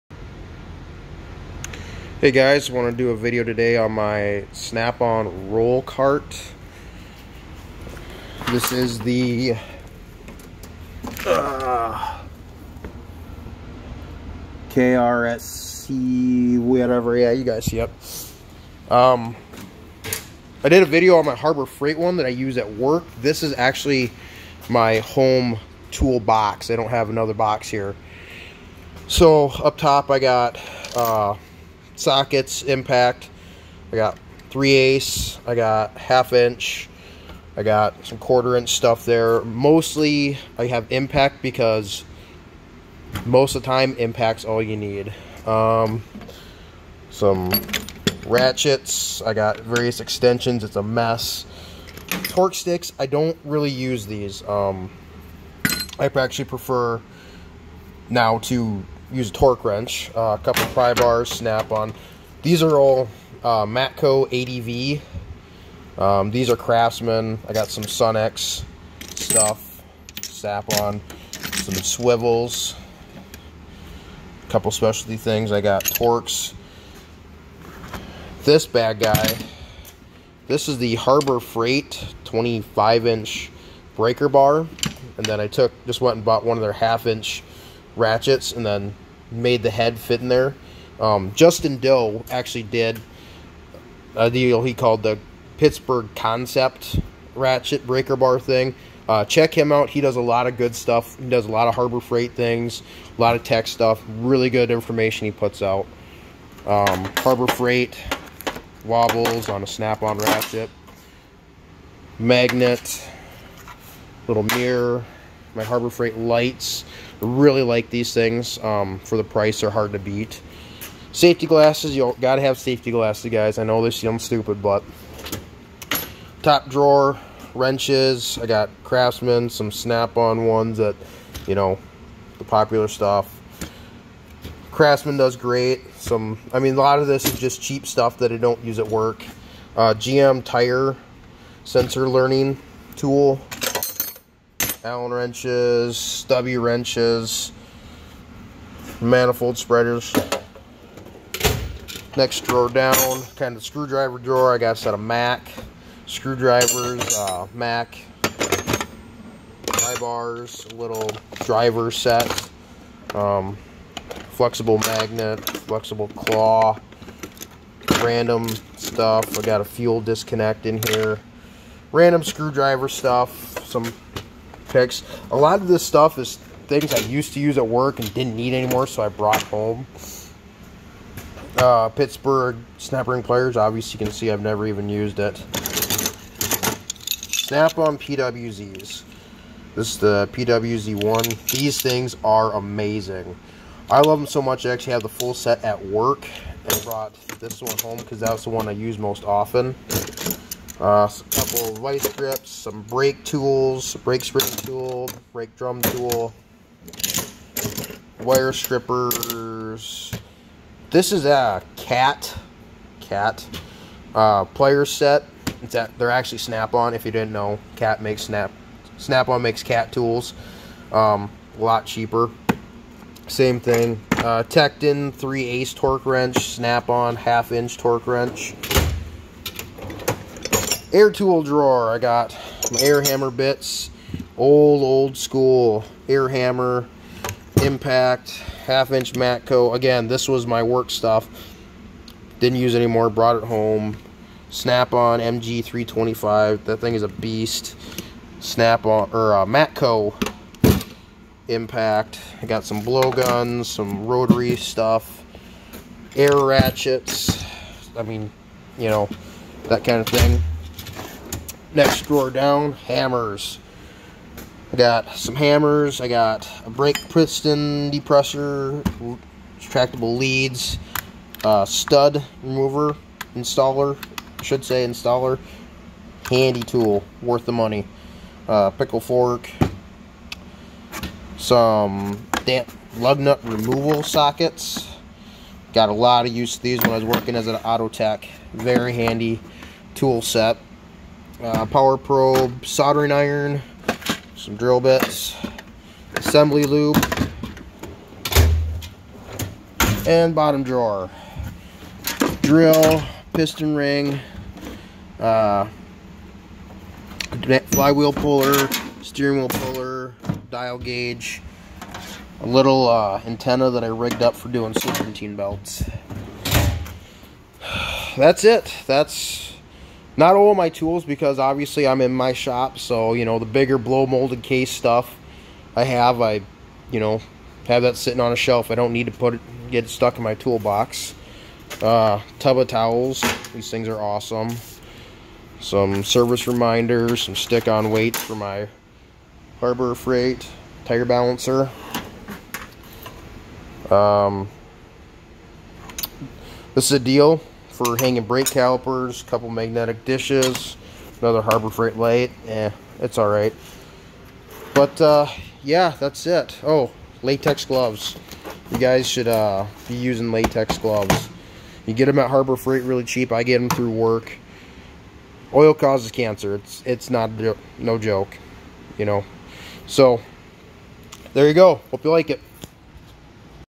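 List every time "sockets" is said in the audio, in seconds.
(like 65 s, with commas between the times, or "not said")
32 s, 284 s.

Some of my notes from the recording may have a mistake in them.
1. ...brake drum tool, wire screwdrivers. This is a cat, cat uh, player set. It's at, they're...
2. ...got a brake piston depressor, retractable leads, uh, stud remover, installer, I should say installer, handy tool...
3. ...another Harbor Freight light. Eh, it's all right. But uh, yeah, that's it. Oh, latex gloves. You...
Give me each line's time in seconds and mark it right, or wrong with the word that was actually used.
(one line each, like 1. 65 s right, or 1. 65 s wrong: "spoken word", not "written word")
1. 205 s wrong: "strippers", not "screwdrivers"
2. 266 s right
3. 351 s right.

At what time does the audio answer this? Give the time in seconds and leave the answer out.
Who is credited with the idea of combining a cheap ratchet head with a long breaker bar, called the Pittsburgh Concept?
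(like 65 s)
91 s.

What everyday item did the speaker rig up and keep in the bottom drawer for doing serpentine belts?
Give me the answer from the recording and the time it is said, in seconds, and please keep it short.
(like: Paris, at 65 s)
antenna, at 313 s.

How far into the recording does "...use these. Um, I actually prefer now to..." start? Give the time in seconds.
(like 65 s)
53 s.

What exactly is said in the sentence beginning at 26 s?
I don't have another box here.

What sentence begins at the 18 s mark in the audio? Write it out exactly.
Um, I did a video on my Harbor Freight one that I use at work.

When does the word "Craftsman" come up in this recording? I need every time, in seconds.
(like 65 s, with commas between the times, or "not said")
66 s, 128 s, 134 s.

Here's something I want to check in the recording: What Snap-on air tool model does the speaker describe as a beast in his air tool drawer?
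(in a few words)
MG325.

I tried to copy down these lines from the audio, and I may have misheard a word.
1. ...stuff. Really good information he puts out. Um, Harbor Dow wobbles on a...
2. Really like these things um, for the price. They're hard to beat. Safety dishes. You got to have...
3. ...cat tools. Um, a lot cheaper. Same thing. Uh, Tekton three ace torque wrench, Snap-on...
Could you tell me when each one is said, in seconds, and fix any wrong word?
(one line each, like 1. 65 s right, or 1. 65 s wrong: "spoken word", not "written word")
1. 103 s wrong: "Freight", not "Dow"
2. 117 s wrong: "glasses", not "dishes"
3. 219 s right.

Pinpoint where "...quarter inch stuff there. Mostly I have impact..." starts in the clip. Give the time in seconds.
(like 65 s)
38 s.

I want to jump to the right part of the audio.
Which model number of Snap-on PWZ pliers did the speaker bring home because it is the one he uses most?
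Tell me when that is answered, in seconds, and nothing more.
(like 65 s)
190 s.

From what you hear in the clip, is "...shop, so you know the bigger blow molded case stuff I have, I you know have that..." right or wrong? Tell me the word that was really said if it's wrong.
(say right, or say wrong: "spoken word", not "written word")
right.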